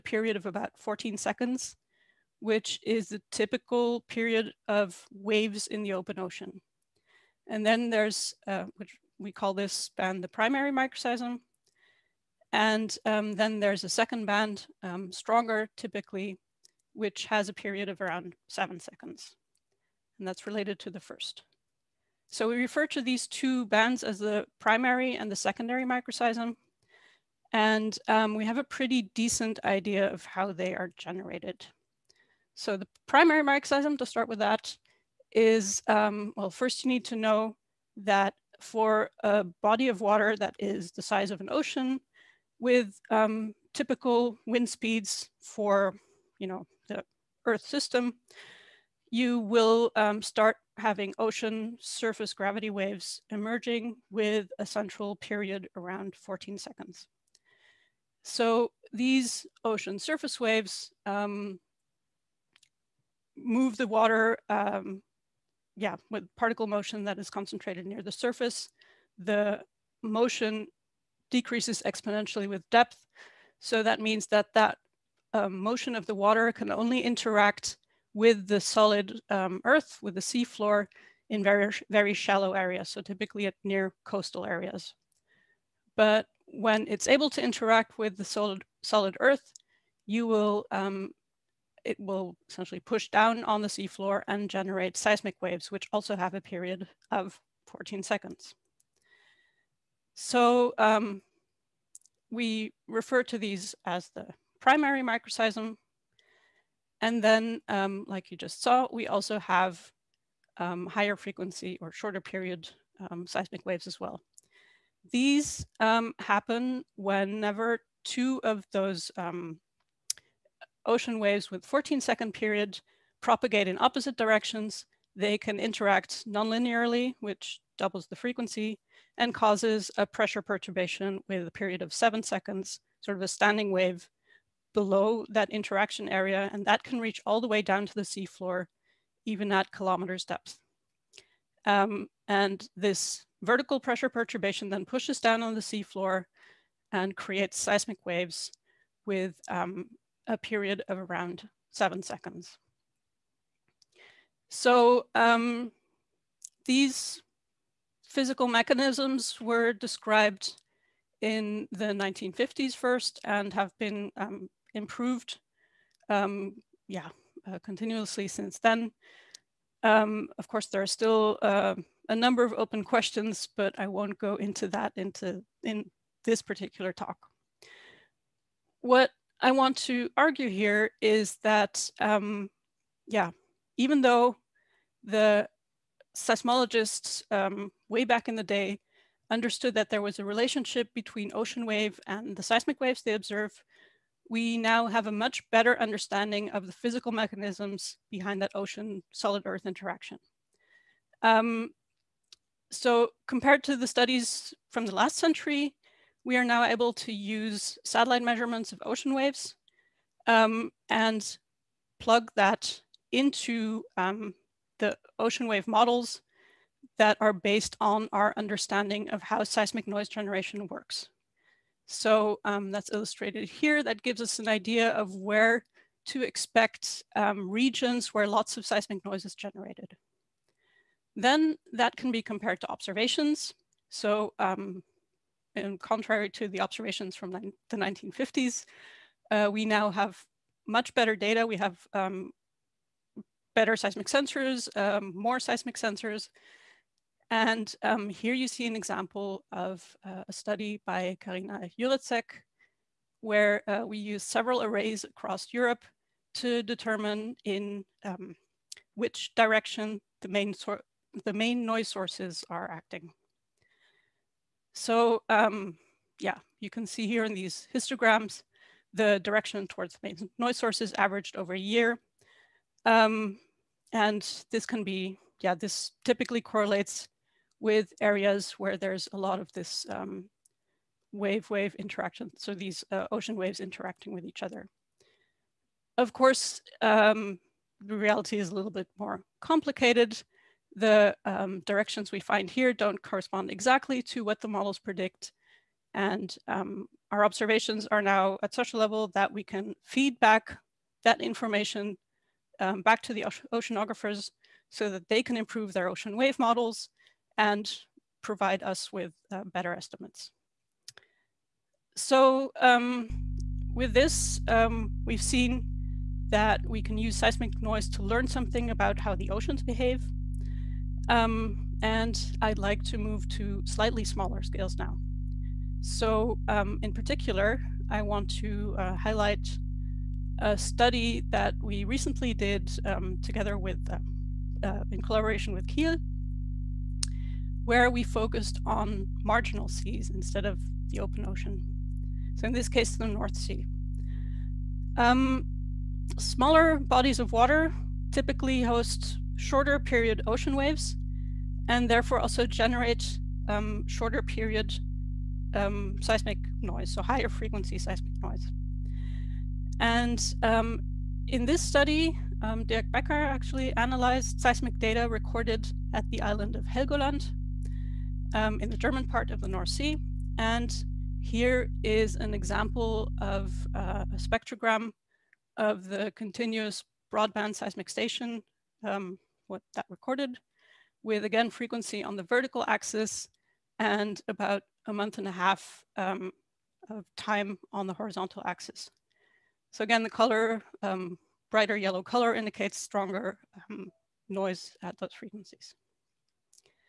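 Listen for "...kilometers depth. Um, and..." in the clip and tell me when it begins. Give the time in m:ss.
2:19.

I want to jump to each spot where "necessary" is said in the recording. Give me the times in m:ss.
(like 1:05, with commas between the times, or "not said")
not said.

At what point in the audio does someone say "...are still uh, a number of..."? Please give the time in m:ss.
2:50.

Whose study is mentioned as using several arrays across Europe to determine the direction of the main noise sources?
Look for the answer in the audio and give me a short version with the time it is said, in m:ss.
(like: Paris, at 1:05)
Carina Juretzek, at 4:11.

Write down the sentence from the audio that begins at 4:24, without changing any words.
So um, yeah, you can see here in these histograms, the direction towards main noise sources averaged over a year.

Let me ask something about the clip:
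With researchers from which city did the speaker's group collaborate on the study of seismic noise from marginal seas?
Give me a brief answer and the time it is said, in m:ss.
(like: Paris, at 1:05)
Kiel, at 5:35.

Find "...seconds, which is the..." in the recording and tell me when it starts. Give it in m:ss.
0:01.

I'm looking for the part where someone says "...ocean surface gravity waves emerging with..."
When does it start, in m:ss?
0:51.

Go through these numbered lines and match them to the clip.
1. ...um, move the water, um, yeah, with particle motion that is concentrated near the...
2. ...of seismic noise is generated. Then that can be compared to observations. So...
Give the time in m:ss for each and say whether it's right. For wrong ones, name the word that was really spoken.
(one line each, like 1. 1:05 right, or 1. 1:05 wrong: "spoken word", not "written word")
1. 1:01 right
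2. 3:48 right.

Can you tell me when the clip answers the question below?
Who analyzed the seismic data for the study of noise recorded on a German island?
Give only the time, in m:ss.
6:02.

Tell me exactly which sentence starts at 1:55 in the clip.
These um, happen whenever two of those um, ocean waves with 14 second period propagate in opposite directions.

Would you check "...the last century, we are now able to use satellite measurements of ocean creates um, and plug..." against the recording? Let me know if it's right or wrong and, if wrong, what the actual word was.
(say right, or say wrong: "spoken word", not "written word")
wrong: "waves", not "creates".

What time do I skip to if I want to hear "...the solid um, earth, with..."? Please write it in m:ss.
1:18.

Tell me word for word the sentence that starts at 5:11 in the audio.
So um, with this, um, we've seen that we can use seismic noise to learn something about how the oceans behave.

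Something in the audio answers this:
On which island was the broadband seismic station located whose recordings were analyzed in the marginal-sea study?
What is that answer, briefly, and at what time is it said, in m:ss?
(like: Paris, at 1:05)
Helgoland, at 6:06.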